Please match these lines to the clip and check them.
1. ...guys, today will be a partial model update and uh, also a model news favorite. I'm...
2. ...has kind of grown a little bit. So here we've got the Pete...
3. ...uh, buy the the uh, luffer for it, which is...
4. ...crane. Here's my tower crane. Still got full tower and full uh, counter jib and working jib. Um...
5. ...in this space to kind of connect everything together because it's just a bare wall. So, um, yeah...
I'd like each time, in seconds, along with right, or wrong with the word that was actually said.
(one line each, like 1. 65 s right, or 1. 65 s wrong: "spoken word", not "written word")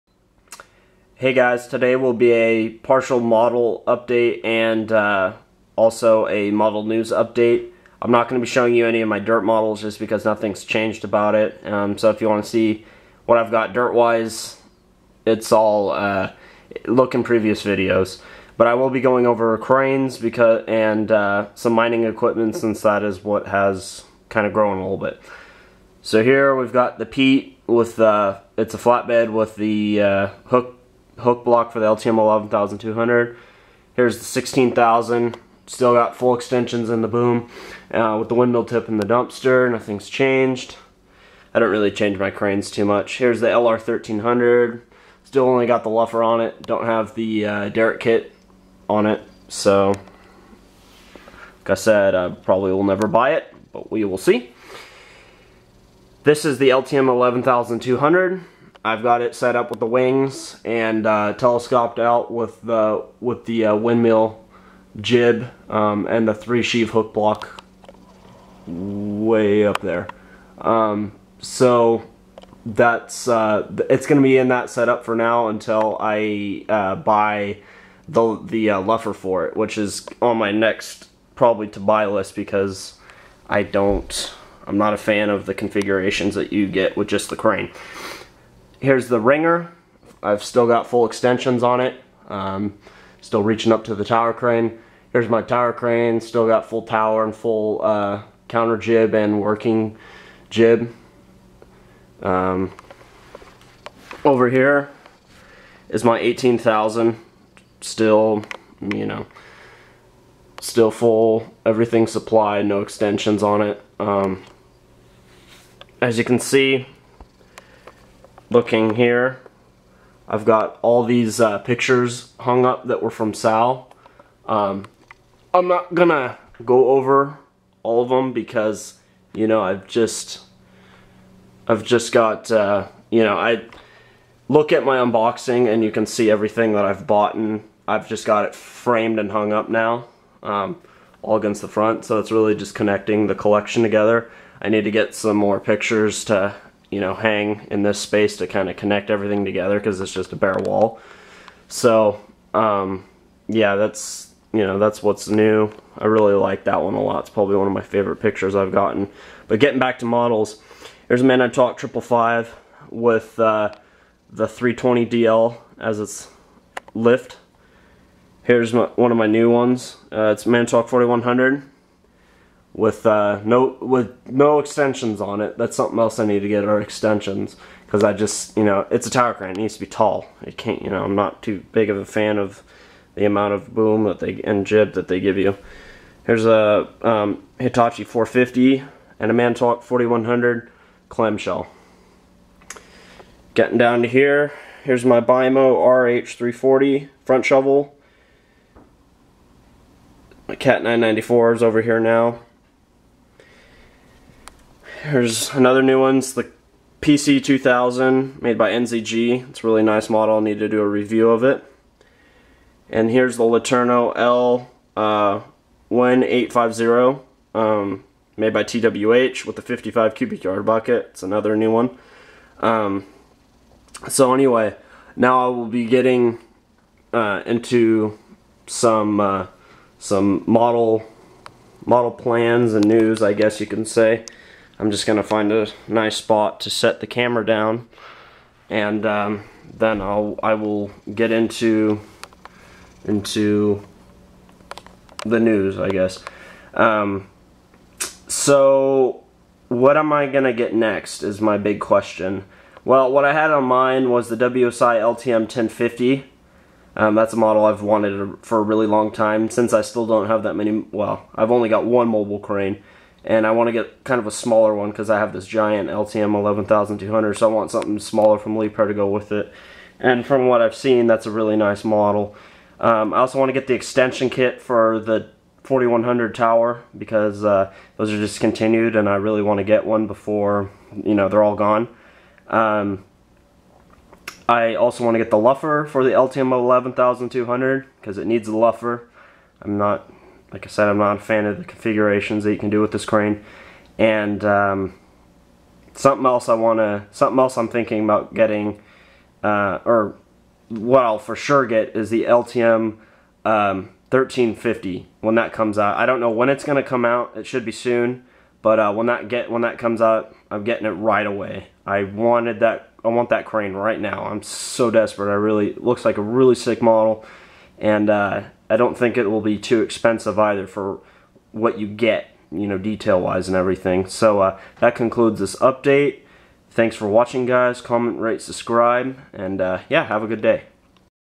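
1. 1 s wrong: "update", not "favorite"
2. 23 s right
3. 76 s right
4. 94 s right
5. 147 s right.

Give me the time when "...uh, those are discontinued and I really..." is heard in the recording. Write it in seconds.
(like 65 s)
277 s.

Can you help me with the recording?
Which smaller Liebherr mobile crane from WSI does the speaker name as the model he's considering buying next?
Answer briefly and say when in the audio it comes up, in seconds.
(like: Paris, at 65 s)
LTM 1050, at 254 s.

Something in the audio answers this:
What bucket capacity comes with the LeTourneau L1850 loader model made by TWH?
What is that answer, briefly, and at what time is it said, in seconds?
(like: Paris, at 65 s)
55 cubic yards, at 219 s.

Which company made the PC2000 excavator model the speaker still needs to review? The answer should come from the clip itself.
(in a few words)
NZG.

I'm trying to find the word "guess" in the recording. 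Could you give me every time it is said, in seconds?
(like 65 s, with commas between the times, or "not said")
233 s, 245 s.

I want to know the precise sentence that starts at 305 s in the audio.
I don't know when it's going to come out.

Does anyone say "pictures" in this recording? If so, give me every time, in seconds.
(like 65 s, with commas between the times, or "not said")
121 s, 145 s, 158 s.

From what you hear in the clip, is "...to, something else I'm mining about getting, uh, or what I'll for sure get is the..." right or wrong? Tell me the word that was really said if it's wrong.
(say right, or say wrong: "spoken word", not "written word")
wrong: "thinking", not "mining".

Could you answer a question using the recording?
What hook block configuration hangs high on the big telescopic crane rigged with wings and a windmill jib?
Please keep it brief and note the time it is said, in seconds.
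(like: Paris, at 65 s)
three sheave, at 66 s.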